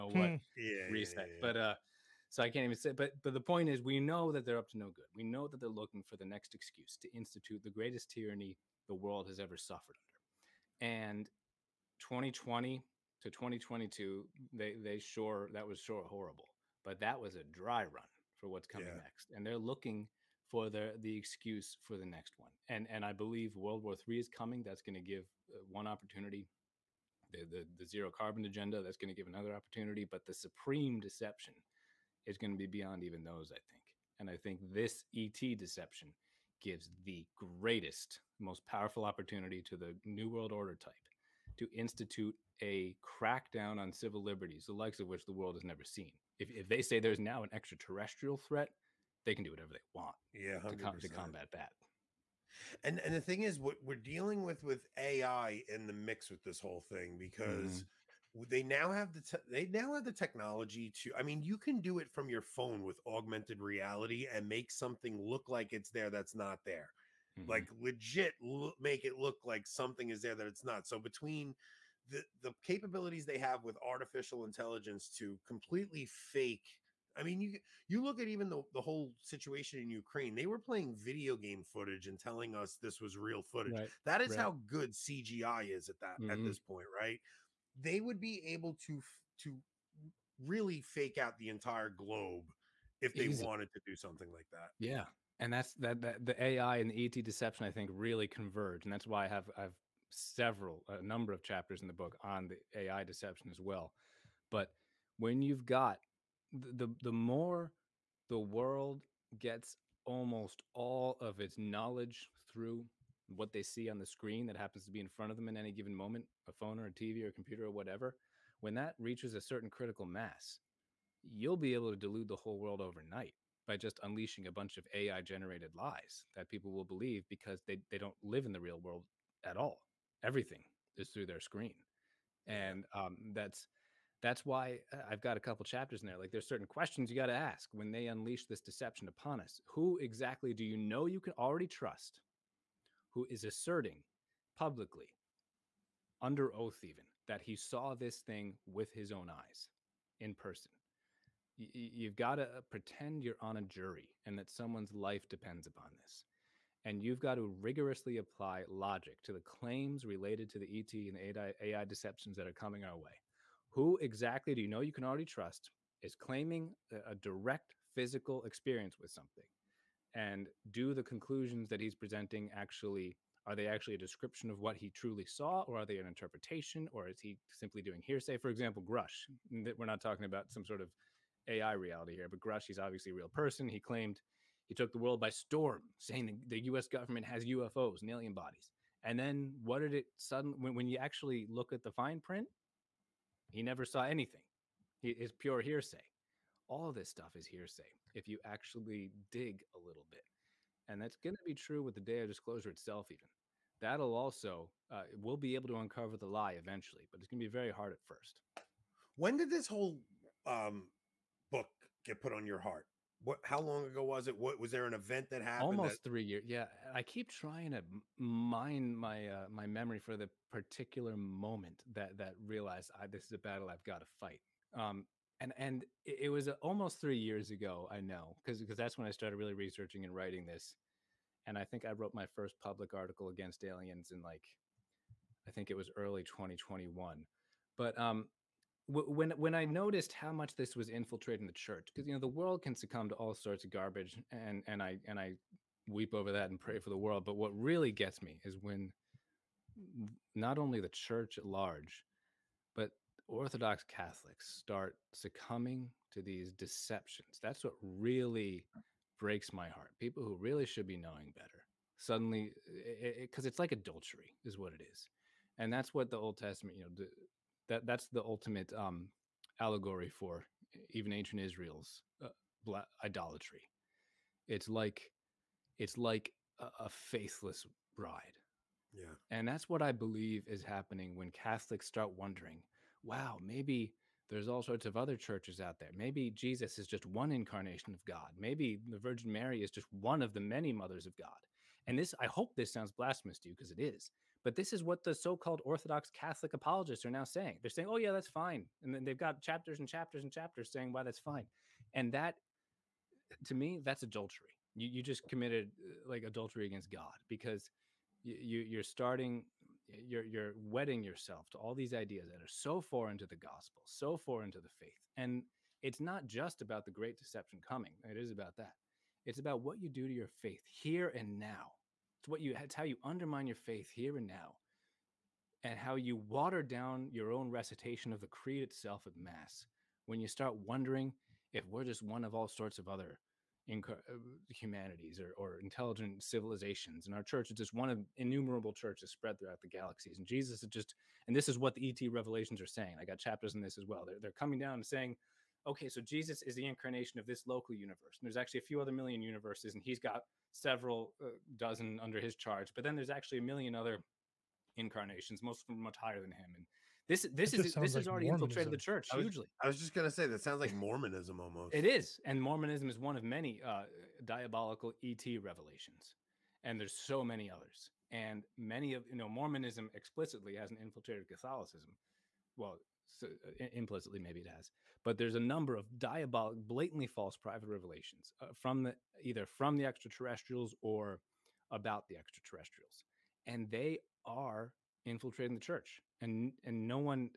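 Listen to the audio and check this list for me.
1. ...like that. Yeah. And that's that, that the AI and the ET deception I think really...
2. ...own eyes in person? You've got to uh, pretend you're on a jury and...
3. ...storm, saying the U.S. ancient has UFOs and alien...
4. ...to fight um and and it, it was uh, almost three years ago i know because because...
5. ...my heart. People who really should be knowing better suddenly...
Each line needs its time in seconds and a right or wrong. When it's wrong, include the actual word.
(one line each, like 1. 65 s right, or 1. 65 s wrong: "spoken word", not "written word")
1. 94 s right
2. 149 s right
3. 185 s wrong: "government", not "ancient"
4. 223 s right
5. 259 s right.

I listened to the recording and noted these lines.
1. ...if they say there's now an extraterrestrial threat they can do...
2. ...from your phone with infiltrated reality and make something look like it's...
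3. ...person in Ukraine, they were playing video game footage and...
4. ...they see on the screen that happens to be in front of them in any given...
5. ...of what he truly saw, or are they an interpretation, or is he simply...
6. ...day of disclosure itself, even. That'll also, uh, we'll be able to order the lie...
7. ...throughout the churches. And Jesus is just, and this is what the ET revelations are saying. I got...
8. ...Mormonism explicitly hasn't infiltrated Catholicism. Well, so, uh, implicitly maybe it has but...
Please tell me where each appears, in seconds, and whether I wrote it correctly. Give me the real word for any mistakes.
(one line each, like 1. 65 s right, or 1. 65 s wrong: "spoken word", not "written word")
1. 46 s right
2. 62 s wrong: "augmented", not "infiltrated"
3. 79 s wrong: "situation", not "person"
4. 113 s right
5. 174 s right
6. 201 s wrong: "uncover", not "order"
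7. 339 s wrong: "galaxies", not "churches"
8. 369 s right.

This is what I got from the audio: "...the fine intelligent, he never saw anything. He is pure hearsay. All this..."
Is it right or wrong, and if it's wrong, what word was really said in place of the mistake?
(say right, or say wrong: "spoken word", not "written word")
wrong: "print", not "intelligent".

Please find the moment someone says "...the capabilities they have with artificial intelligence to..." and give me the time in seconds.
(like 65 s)
72 s.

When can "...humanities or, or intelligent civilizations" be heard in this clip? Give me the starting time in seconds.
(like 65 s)
334 s.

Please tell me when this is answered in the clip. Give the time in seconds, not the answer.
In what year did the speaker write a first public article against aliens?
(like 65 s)
236 s.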